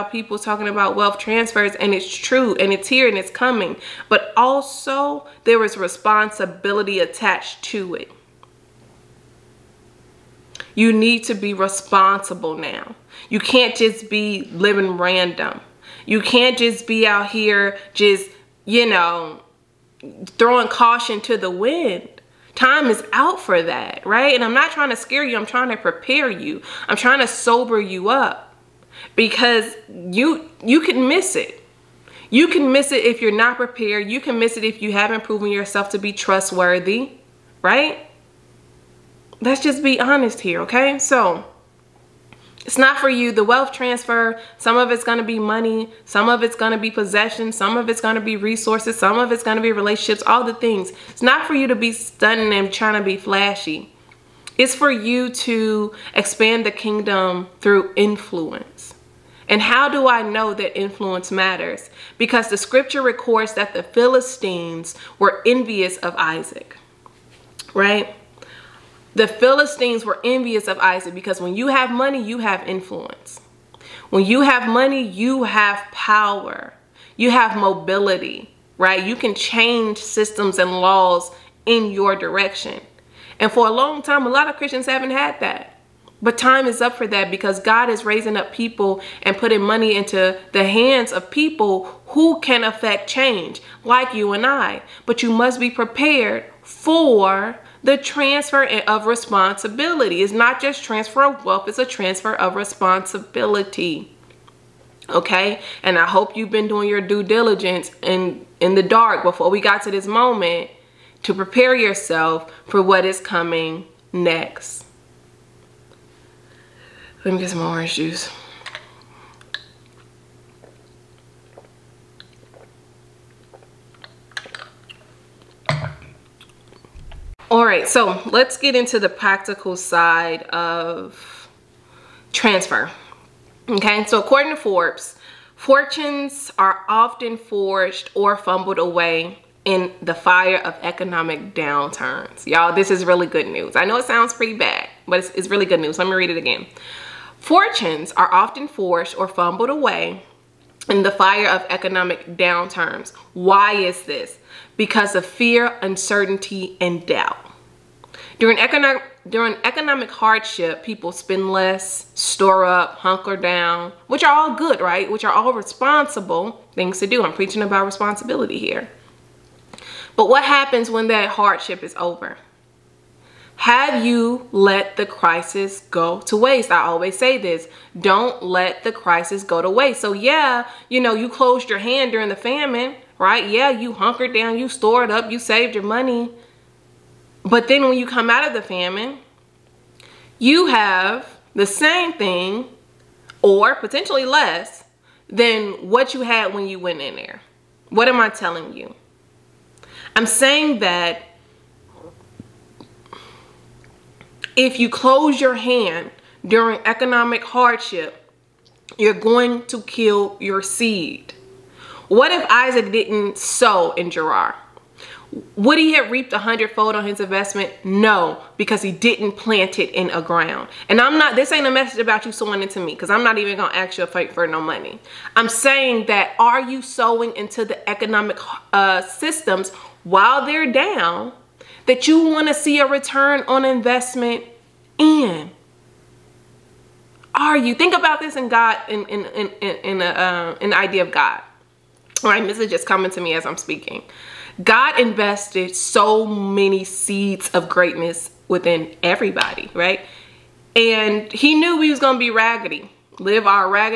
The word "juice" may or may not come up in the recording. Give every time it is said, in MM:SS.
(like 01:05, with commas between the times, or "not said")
01:57.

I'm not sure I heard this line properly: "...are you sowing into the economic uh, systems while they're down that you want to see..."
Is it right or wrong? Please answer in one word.
right.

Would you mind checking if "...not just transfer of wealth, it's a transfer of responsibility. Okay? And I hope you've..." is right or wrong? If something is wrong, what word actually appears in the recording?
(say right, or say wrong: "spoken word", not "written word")
right.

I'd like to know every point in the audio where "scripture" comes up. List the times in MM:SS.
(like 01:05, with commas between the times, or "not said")
01:02.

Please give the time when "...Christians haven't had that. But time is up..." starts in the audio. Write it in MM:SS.
01:24.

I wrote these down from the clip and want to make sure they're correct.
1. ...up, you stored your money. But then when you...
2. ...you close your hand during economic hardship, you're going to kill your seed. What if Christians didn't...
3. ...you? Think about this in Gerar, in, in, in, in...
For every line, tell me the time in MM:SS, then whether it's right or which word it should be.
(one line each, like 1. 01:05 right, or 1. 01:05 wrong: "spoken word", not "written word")
1. 03:05 wrong: "saved", not "stored"
2. 03:24 wrong: "Isaac", not "Christians"
3. 03:57 wrong: "God", not "Gerar".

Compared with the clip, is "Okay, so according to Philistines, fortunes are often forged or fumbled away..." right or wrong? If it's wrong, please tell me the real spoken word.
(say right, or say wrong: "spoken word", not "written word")
wrong: "Forbes", not "Philistines".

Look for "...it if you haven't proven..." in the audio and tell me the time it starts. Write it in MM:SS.
00:34.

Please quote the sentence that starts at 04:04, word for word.
God invested so many seeds of greatness within everybody, right?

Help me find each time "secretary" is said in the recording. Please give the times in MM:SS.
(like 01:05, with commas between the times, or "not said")
not said.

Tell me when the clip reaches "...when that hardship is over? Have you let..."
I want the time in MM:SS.
02:50.